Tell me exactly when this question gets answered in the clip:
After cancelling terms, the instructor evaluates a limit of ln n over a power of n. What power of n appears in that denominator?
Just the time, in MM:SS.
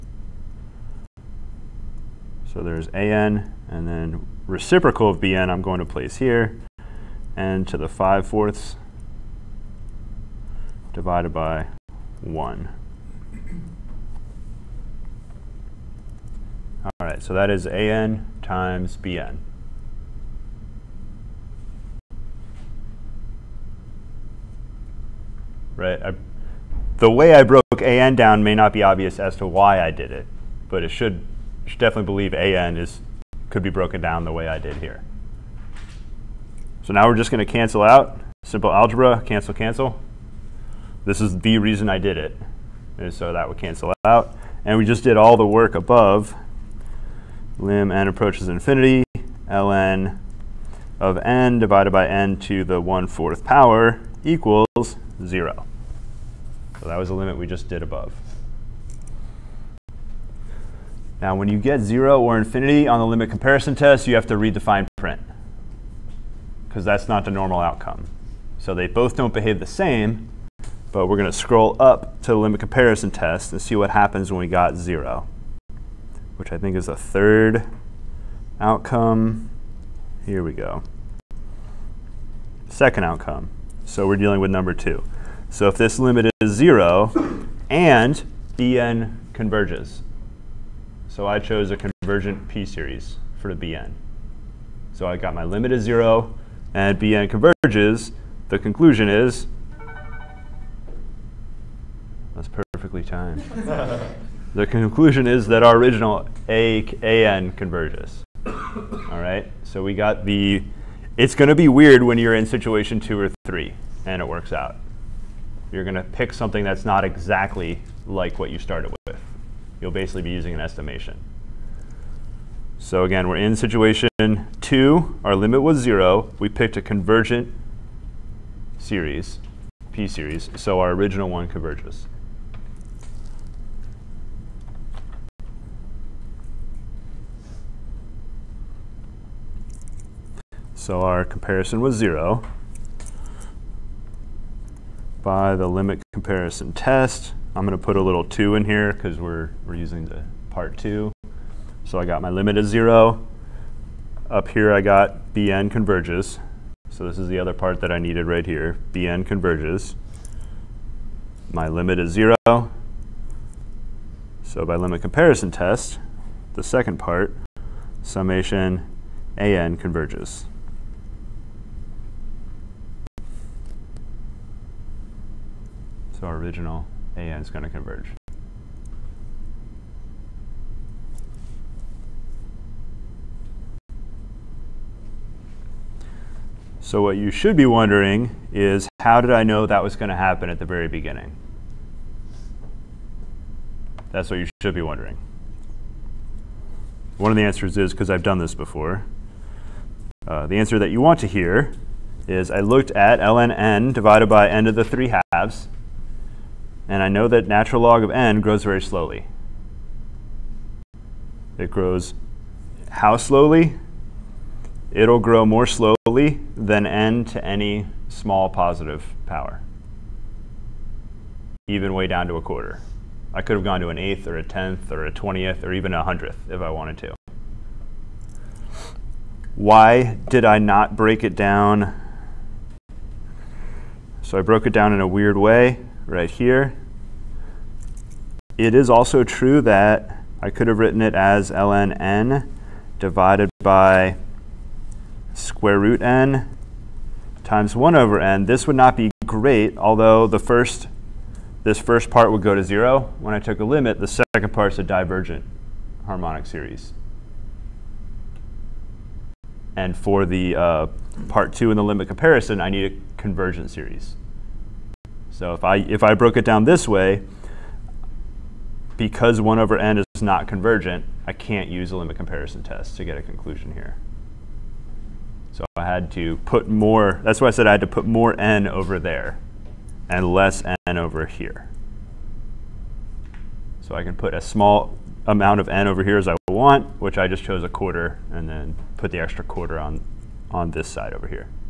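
00:52.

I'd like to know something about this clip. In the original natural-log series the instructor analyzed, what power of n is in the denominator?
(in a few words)
3/2.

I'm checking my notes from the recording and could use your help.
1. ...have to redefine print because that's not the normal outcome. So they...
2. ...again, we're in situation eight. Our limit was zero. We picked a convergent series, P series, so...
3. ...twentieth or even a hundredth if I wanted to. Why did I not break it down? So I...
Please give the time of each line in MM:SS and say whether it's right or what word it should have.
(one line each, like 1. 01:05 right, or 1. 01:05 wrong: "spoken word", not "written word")
1. 01:04 right
2. 02:03 wrong: "two", not "eight"
3. 03:45 right.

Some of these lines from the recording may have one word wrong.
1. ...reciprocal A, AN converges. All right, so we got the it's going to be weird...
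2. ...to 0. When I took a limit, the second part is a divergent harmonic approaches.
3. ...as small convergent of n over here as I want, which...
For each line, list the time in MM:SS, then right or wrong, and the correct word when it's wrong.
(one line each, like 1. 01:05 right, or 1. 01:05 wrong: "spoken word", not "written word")
1. 01:45 wrong: "original", not "reciprocal"
2. 04:12 wrong: "series", not "approaches"
3. 04:44 wrong: "amount", not "convergent".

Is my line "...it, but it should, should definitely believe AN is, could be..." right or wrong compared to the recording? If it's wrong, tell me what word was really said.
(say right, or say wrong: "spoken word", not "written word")
right.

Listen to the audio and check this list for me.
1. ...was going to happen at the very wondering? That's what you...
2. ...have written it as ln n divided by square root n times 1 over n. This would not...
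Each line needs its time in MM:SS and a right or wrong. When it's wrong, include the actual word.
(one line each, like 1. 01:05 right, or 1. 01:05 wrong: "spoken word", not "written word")
1. 03:09 wrong: "beginning", not "wondering"
2. 04:00 right.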